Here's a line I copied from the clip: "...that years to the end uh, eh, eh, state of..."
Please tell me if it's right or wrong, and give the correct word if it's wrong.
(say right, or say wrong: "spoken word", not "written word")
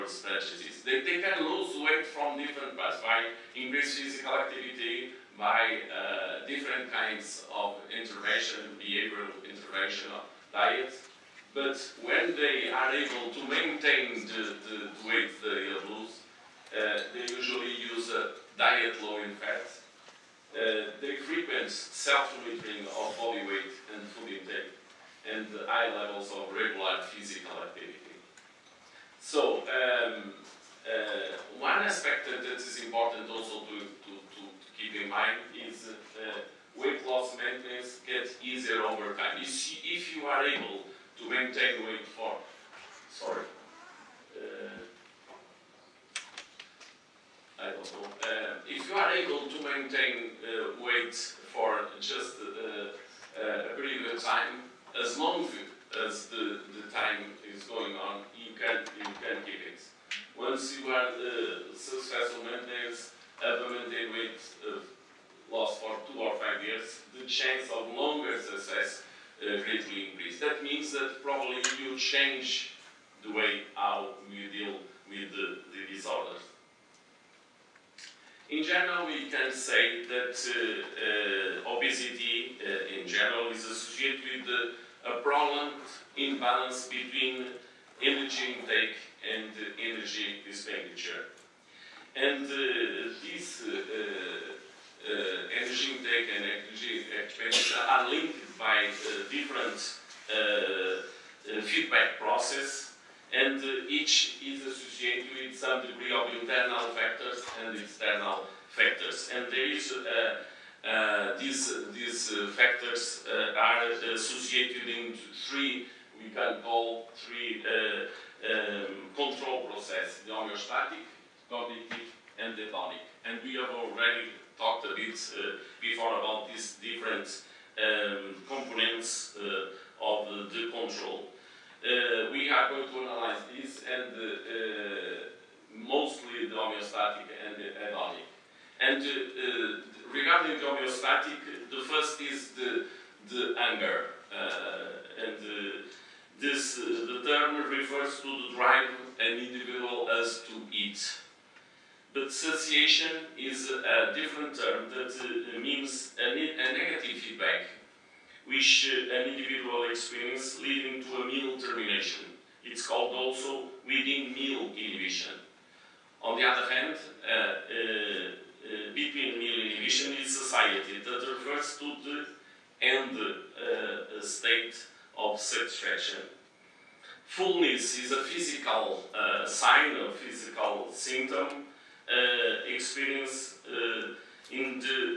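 wrong: "refers", not "years".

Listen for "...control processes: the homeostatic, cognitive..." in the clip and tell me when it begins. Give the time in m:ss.
1:59.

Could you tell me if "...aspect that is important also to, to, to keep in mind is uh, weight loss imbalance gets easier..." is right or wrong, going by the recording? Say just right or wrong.
wrong.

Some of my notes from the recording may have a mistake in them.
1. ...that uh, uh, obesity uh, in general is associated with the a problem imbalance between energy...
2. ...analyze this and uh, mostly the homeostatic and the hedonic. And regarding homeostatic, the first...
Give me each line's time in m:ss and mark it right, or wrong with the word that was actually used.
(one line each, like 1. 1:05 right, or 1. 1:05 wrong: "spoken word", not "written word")
1. 1:20 right
2. 2:12 right.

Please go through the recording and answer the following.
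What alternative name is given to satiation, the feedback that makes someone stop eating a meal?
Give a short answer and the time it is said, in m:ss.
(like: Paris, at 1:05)
within meal inhibition, at 2:43.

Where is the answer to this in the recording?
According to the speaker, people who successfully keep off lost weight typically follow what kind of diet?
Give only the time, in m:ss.
0:19.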